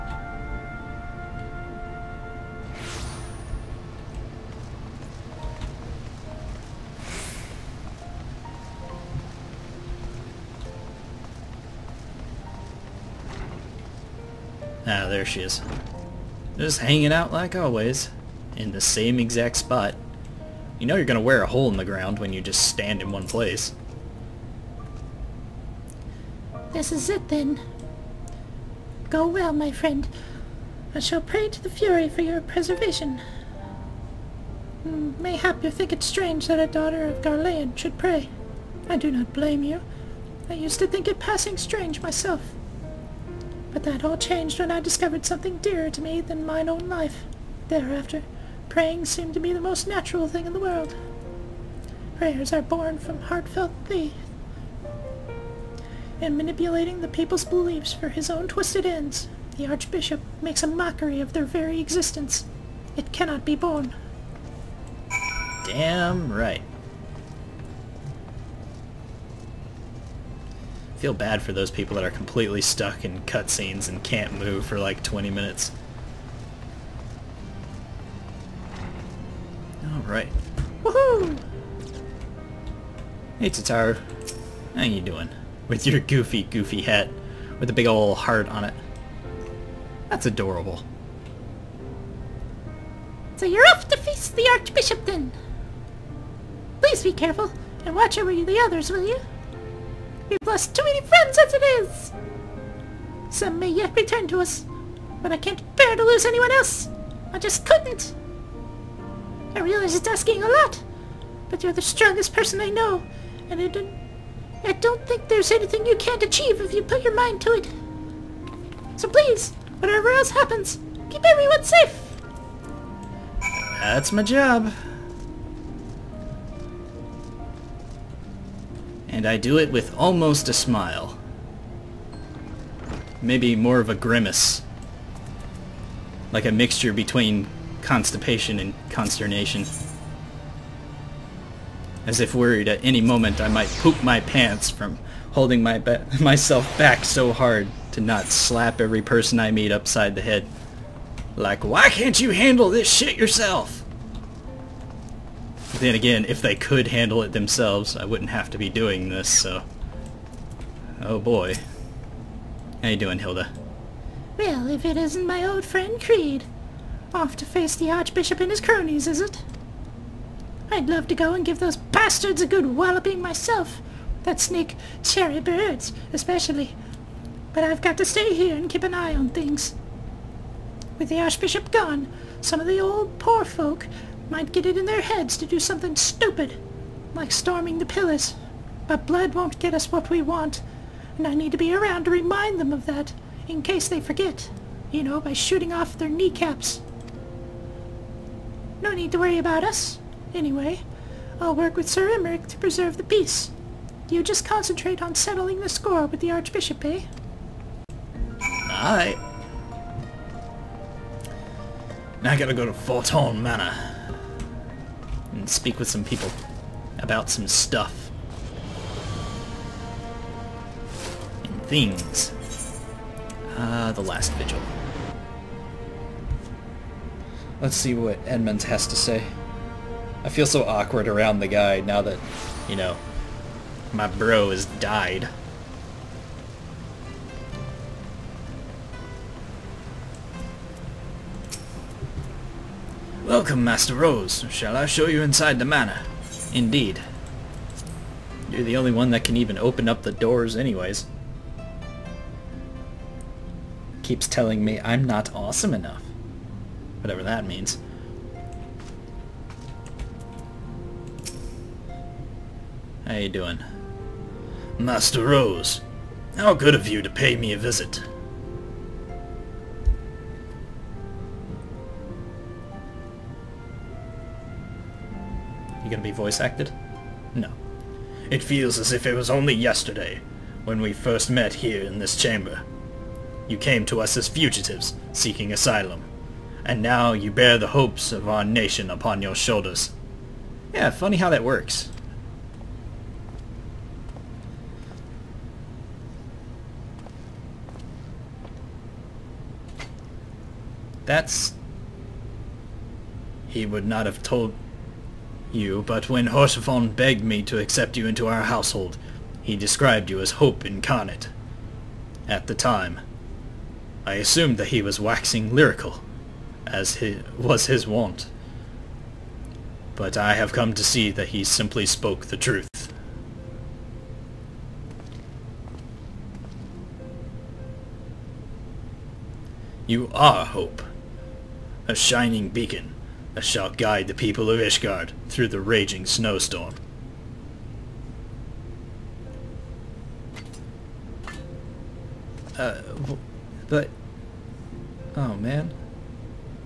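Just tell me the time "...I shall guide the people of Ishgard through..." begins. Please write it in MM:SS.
05:33.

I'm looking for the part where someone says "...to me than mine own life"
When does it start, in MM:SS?
00:45.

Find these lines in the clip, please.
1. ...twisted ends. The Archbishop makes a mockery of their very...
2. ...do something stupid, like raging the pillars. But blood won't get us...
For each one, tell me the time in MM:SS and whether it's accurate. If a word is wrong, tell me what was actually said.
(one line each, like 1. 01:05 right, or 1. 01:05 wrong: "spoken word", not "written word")
1. 00:58 right
2. 03:05 wrong: "storming", not "raging".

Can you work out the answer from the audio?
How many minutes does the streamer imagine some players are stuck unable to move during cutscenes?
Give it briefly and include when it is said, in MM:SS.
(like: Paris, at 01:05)
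20, at 01:15.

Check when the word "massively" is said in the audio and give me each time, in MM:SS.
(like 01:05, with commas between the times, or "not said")
not said.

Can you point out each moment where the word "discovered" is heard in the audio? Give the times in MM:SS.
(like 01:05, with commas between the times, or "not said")
00:44.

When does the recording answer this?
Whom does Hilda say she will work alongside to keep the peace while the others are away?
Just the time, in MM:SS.
03:21.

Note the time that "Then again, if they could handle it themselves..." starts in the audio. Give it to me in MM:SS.
02:35.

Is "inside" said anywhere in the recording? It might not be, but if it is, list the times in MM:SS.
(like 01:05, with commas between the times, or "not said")
04:05.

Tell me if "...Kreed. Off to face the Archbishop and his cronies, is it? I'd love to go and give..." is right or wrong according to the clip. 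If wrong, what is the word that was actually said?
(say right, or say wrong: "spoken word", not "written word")
right.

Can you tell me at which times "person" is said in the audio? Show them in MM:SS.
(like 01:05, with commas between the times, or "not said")
01:52, 02:29.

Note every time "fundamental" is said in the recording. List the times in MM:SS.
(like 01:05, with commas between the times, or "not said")
not said.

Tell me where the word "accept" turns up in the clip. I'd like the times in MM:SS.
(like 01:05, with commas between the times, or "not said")
05:07.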